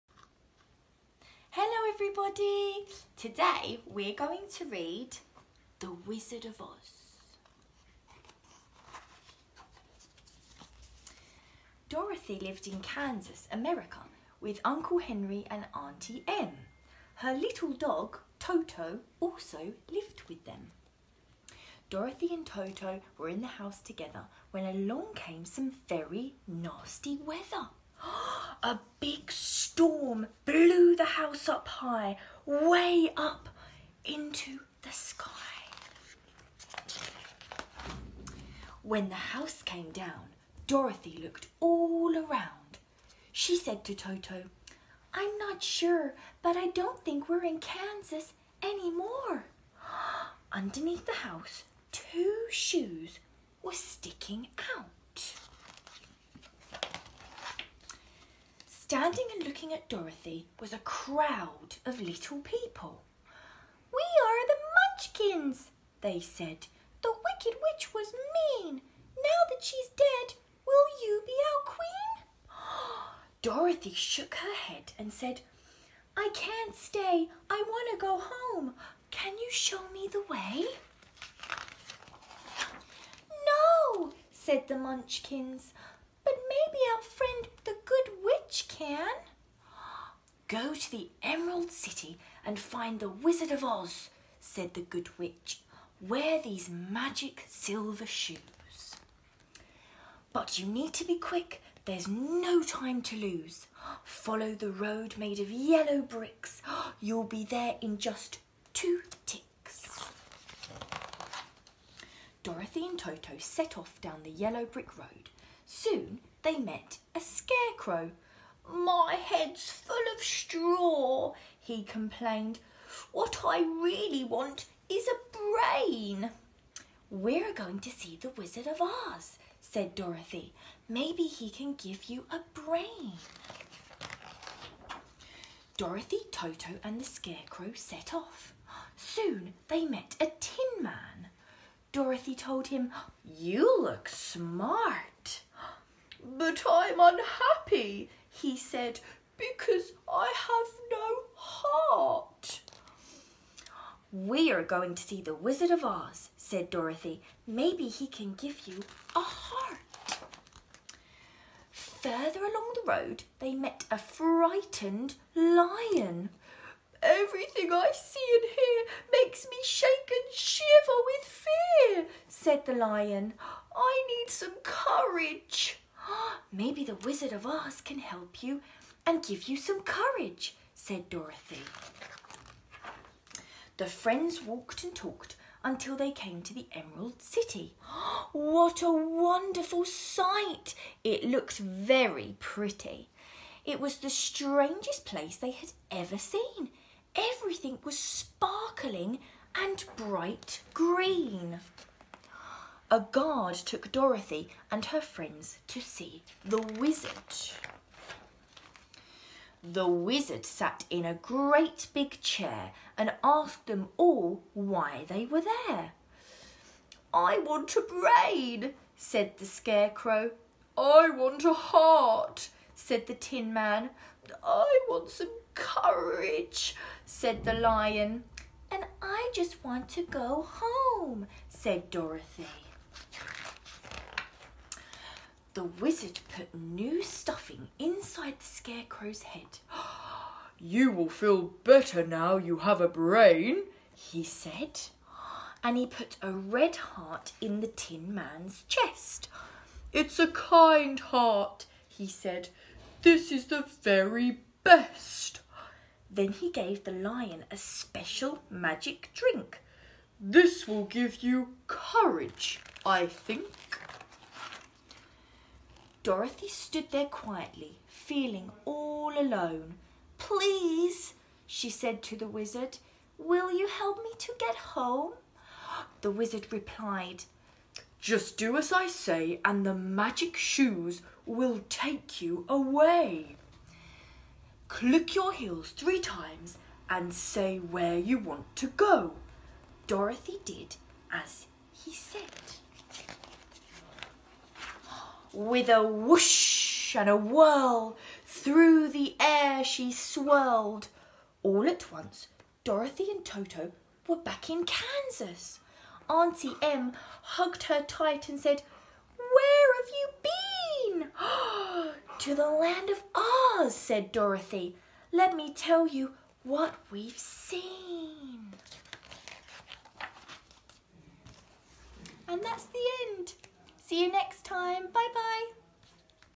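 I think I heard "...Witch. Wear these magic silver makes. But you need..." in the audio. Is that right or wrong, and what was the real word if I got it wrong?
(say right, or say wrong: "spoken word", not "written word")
wrong: "shoes", not "makes".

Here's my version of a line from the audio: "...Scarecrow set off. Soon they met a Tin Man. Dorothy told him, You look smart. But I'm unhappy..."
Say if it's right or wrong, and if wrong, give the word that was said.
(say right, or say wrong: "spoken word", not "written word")
right.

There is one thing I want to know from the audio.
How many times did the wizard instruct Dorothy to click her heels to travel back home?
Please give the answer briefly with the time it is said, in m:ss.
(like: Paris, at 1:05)
3, at 4:45.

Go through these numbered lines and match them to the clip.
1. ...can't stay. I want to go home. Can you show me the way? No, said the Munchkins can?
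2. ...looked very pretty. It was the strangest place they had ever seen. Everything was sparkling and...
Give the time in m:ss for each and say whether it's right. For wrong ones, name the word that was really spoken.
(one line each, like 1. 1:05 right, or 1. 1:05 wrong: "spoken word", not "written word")
1. 1:16 right
2. 3:11 right.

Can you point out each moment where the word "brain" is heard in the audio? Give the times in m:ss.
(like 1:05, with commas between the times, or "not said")
2:05, 2:12, 3:37, 4:02.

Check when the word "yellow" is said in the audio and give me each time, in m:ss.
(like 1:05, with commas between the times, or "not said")
1:45, 1:54.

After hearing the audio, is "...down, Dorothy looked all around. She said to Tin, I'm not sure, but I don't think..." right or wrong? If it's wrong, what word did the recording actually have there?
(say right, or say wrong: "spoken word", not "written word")
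wrong: "Toto", not "Tin".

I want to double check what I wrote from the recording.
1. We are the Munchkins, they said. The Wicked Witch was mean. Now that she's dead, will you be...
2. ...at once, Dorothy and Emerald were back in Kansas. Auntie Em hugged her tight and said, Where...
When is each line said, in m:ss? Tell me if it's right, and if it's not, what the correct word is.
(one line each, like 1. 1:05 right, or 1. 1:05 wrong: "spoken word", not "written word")
1. 1:03 right
2. 5:01 wrong: "Toto", not "Emerald".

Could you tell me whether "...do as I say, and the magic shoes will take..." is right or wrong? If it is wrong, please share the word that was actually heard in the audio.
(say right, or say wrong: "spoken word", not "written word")
right.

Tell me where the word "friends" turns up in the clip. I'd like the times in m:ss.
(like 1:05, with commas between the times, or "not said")
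3:03, 3:24.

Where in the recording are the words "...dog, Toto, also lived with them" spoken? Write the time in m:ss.
0:17.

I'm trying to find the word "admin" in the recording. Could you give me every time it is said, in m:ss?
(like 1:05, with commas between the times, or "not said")
not said.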